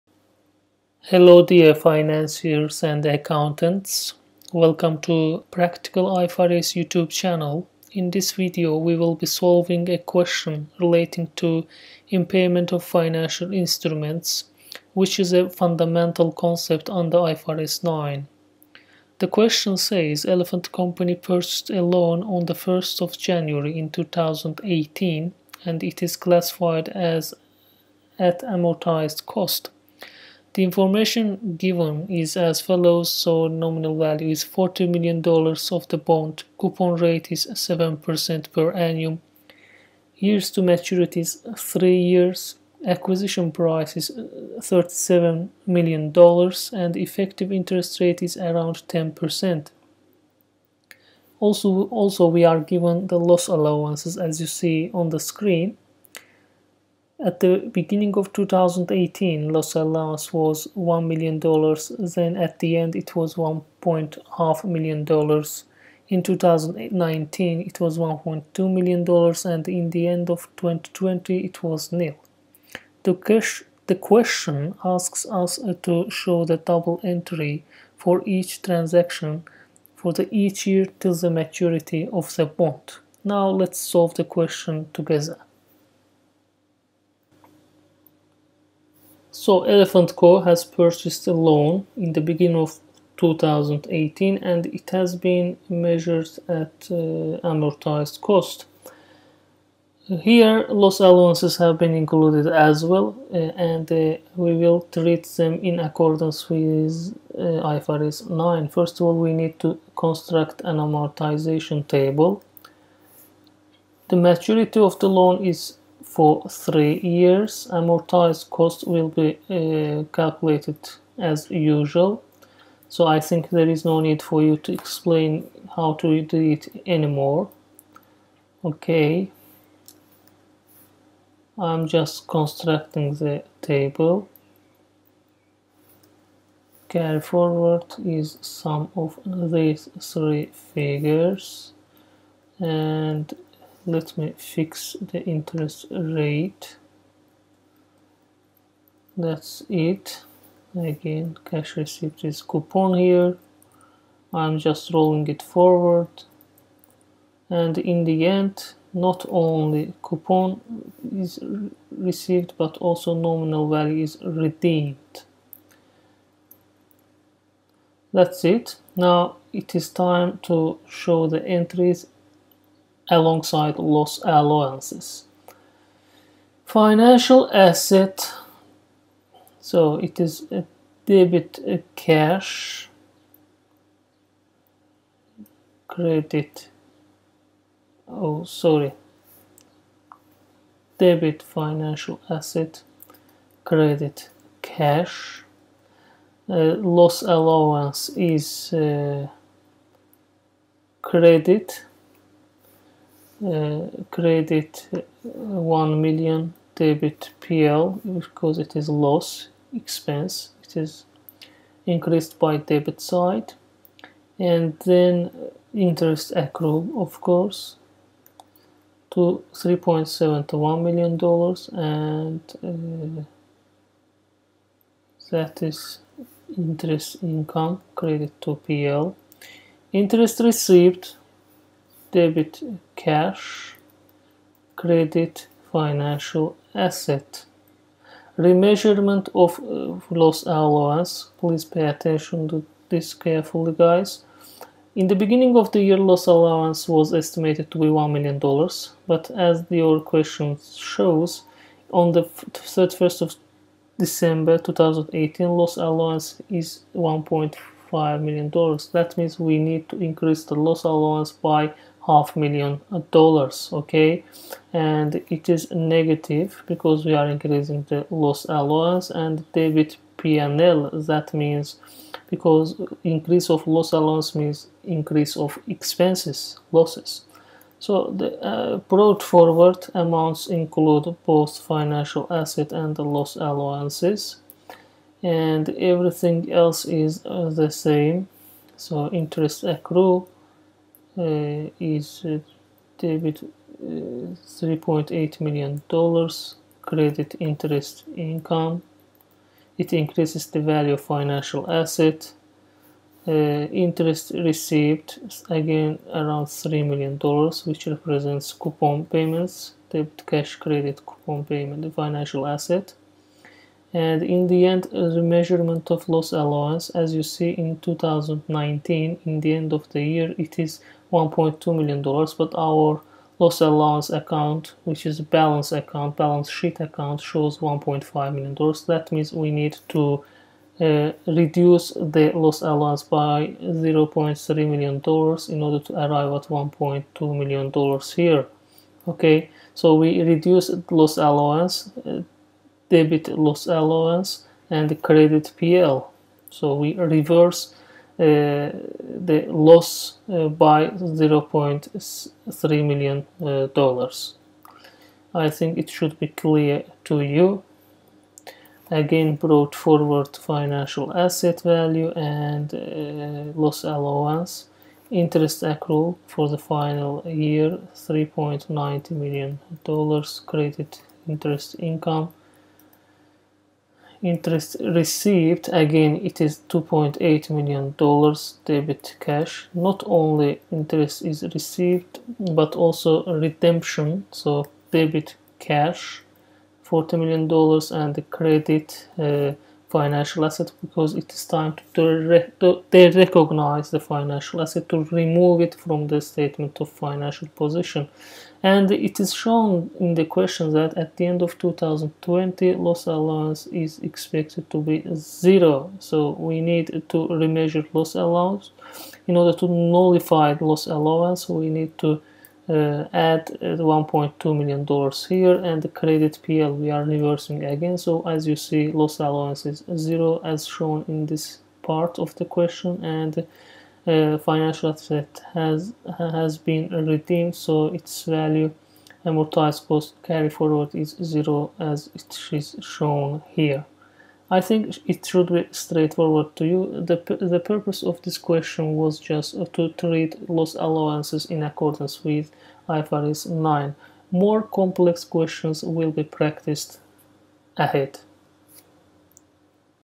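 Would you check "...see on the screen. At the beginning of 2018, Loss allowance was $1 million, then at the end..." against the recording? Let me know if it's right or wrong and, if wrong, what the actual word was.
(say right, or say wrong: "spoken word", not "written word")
right.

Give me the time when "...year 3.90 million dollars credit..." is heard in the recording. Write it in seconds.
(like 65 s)
367 s.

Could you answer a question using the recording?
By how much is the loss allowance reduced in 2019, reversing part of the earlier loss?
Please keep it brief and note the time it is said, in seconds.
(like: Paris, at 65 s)
0.3 million dollars, at 333 s.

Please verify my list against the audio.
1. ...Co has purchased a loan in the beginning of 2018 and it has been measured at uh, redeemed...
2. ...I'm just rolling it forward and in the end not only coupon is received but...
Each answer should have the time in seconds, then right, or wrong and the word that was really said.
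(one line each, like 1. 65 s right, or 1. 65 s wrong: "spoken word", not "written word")
1. 90 s wrong: "amortized", not "redeemed"
2. 154 s right.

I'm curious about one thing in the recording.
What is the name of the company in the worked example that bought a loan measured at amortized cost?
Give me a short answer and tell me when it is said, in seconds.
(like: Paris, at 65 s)
Elephant Company, at 20 s.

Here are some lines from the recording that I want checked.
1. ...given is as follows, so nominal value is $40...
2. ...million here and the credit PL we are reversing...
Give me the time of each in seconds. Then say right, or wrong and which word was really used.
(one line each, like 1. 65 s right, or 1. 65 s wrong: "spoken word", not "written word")
1. 31 s right
2. 414 s right.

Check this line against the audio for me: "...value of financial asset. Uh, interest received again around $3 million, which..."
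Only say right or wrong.
right.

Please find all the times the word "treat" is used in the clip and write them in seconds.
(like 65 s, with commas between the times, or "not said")
104 s, 439 s.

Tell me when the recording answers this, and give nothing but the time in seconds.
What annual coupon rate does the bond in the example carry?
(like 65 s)
37 s.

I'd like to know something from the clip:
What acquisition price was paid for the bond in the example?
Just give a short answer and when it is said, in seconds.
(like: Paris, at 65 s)
$37 million, at 44 s.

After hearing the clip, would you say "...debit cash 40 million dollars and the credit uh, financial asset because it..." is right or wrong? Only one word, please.
right.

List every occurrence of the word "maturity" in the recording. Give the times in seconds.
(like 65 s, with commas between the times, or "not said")
40 s, 81 s, 114 s.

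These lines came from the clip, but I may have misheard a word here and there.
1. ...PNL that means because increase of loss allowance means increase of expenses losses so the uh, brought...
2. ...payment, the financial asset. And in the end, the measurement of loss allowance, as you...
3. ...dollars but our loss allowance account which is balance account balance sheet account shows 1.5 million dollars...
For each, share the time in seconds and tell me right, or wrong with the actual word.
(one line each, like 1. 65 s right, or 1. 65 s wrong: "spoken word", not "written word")
1. 270 s right
2. 311 s right
3. 322 s right.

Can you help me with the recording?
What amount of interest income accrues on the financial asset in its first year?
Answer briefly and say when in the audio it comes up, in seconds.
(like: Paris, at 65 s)
3.71 million dollars, at 219 s.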